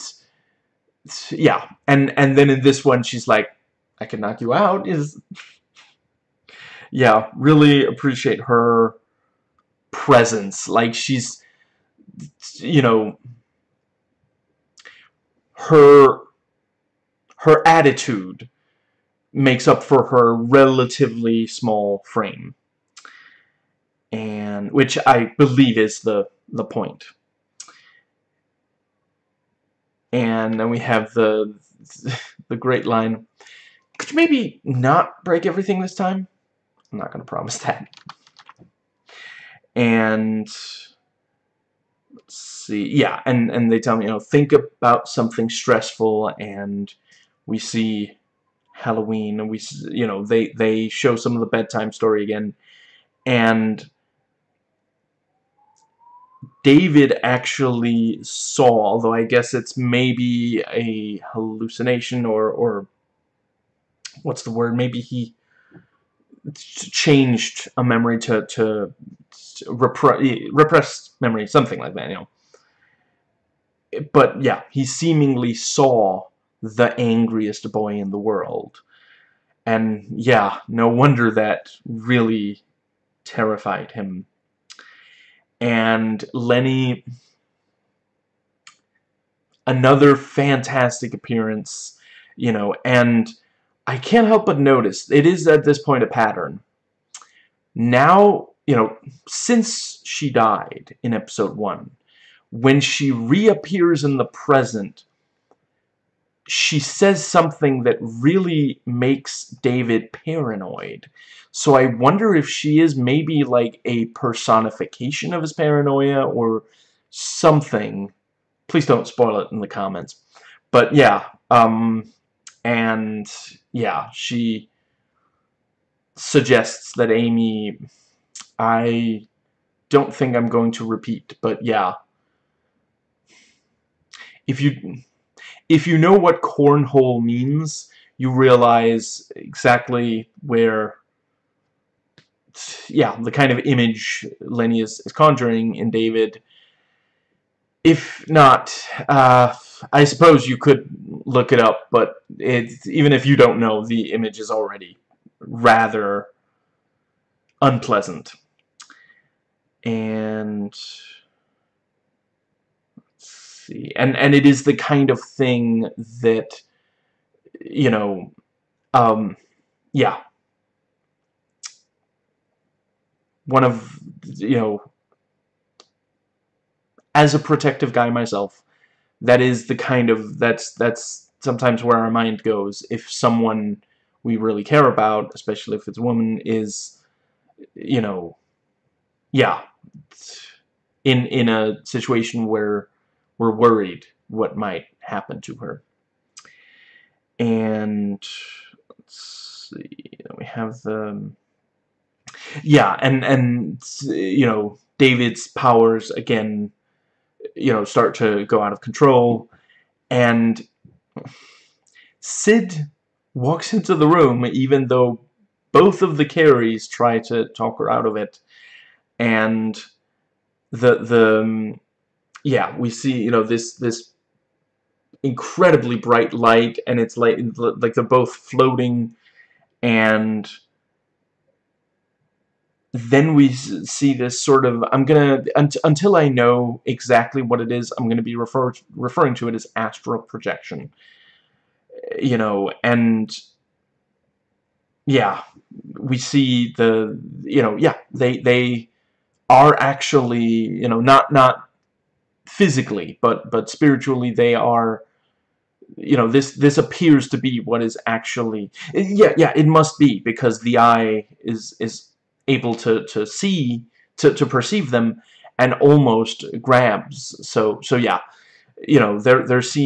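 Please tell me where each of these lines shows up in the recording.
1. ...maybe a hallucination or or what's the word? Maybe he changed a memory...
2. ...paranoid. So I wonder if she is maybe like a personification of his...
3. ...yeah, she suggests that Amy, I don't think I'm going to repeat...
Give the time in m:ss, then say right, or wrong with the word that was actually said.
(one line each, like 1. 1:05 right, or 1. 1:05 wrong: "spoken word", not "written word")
1. 0:59 right
2. 1:50 right
3. 2:03 right.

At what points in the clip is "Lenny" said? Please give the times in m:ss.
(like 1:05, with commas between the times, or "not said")
1:26, 2:24.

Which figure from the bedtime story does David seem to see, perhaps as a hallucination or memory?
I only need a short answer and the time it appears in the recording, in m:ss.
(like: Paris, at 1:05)
The angriest boy in the world, at 1:16.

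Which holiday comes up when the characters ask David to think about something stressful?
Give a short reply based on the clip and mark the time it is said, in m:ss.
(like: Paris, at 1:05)
Halloween, at 0:48.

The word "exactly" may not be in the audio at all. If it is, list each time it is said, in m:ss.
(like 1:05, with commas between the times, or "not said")
2:19, 3:56.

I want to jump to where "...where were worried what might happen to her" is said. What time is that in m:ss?
3:12.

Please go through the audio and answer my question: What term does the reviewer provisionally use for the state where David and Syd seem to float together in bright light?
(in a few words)
Astral projection.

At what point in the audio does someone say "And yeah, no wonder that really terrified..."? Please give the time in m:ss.
1:19.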